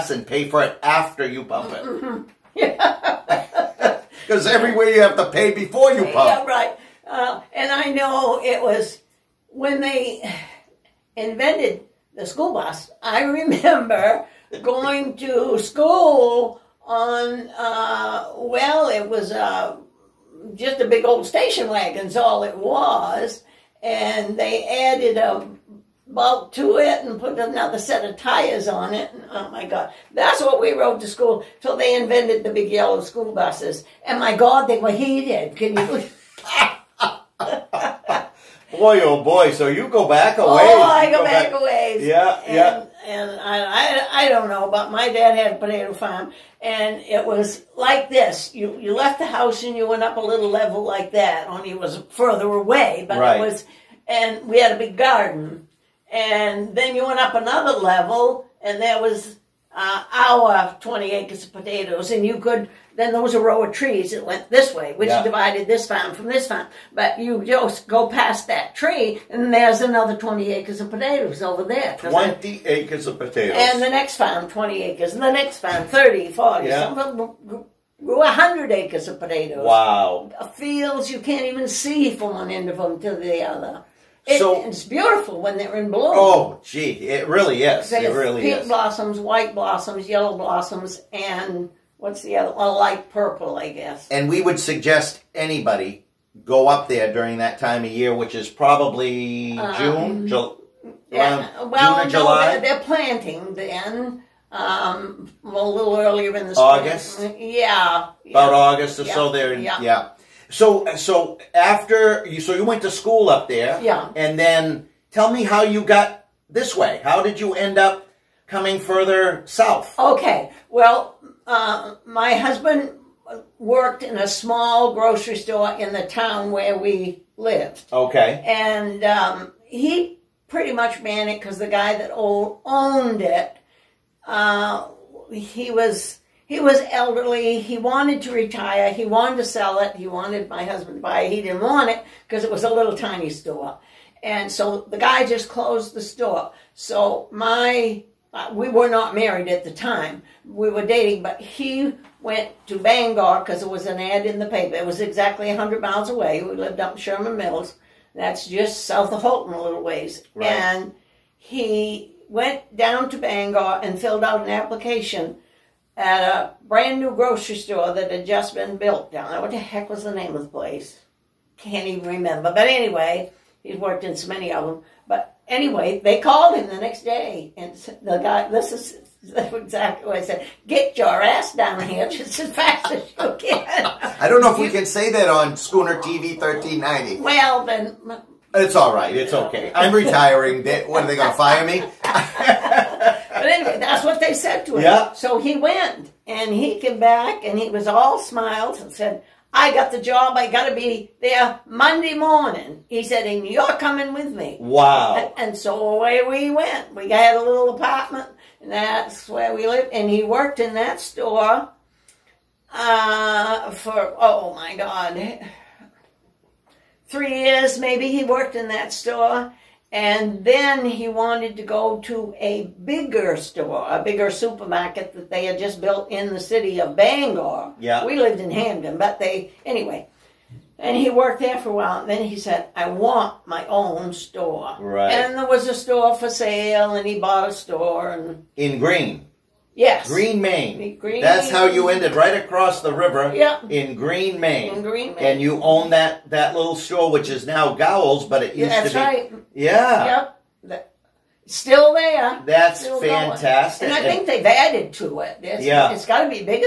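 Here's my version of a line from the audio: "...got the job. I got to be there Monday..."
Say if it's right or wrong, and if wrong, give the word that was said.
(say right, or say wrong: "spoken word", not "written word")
right.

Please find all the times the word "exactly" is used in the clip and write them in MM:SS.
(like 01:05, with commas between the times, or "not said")
02:34, 02:59.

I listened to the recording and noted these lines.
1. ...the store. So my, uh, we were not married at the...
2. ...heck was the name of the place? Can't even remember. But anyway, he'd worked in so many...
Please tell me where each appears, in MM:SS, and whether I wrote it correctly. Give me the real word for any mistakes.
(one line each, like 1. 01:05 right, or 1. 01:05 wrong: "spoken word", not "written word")
1. 02:25 right
2. 02:49 right.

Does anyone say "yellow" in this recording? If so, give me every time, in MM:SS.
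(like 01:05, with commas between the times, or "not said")
00:32, 01:30.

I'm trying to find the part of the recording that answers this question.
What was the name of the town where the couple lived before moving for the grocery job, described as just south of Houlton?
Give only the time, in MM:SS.
02:36.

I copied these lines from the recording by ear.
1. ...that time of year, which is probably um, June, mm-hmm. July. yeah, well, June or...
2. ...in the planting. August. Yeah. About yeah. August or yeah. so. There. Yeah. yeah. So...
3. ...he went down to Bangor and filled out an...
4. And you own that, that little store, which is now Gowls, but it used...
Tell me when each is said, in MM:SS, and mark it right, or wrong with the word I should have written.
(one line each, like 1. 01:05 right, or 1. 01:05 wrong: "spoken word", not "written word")
1. 01:37 right
2. 01:46 wrong: "spring", not "planting"
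3. 02:41 right
4. 04:05 right.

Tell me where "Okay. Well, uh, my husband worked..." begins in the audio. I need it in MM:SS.
01:59.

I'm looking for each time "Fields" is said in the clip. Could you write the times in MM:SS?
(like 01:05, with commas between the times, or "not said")
01:20.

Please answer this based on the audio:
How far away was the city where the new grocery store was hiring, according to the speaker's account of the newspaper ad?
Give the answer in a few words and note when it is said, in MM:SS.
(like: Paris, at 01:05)
100 miles, at 02:35.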